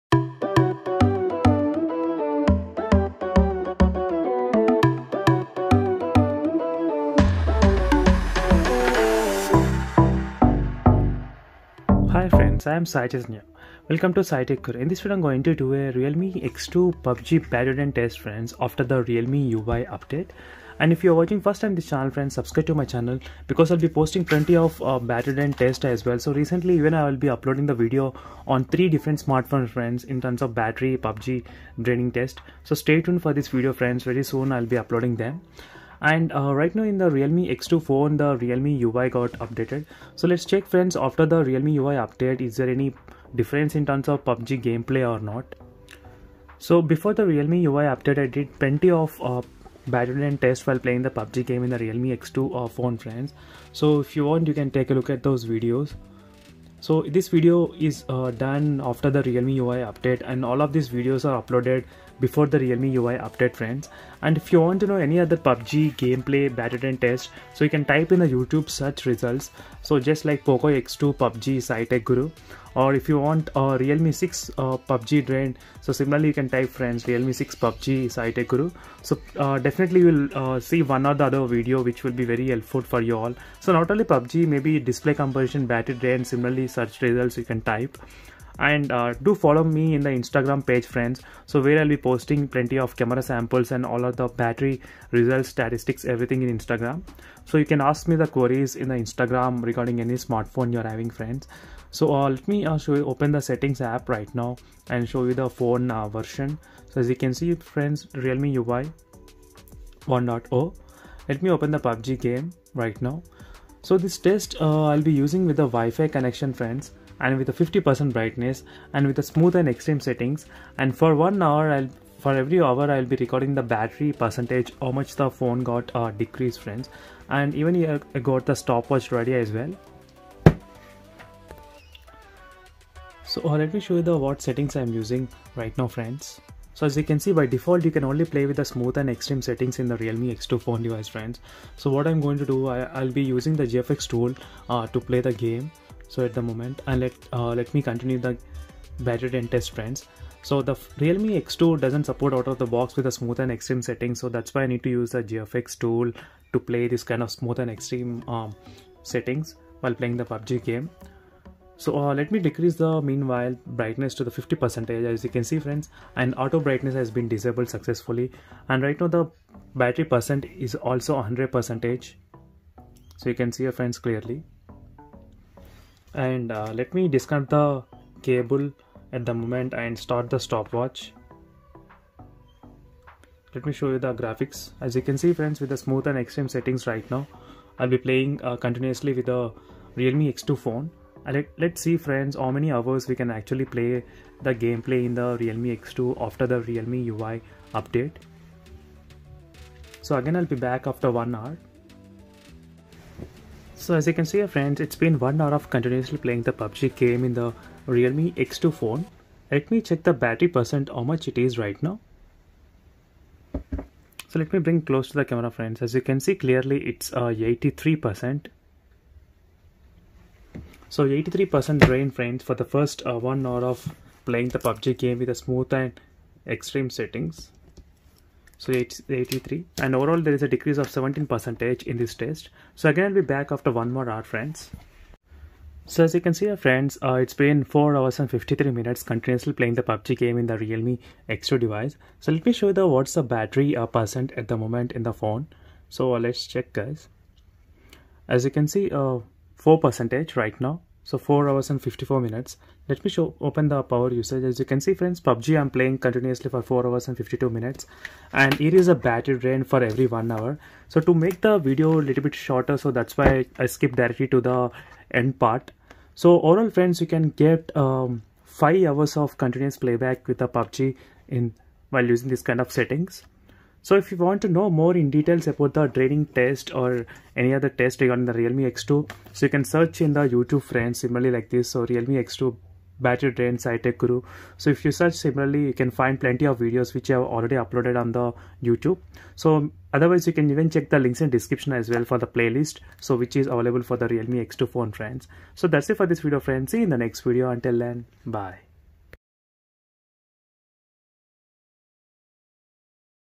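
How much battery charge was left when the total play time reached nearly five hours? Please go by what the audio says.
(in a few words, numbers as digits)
4%.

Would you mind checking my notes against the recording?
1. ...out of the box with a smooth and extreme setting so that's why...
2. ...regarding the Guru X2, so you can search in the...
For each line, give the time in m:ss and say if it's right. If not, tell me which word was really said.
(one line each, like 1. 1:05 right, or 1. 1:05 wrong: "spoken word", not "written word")
1. 2:32 right
2. 4:38 wrong: "Realme", not "Guru".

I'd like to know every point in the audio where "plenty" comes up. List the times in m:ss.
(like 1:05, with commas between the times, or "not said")
0:24, 0:48, 1:32, 4:46.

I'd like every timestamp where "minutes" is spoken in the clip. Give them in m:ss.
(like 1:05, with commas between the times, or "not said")
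3:58, 4:12, 4:17.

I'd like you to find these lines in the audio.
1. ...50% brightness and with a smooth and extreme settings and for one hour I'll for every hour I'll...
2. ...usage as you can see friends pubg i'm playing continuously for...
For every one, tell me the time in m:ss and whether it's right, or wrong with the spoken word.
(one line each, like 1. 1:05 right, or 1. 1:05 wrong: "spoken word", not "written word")
1. 1:57 right
2. 4:14 right.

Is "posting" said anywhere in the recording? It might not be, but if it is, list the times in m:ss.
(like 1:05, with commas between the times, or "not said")
0:23, 1:31.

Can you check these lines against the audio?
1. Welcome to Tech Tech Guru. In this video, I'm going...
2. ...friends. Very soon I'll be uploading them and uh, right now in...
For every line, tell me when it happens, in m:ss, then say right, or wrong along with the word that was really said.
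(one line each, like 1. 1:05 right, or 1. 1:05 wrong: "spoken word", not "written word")
1. 0:13 wrong: "Sai", not "Tech"
2. 0:33 right.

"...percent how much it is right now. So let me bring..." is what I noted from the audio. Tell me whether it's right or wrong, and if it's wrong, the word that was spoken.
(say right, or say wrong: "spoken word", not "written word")
right.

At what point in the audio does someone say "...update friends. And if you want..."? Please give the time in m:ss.
1:03.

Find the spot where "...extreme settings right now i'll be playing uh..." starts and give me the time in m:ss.
3:06.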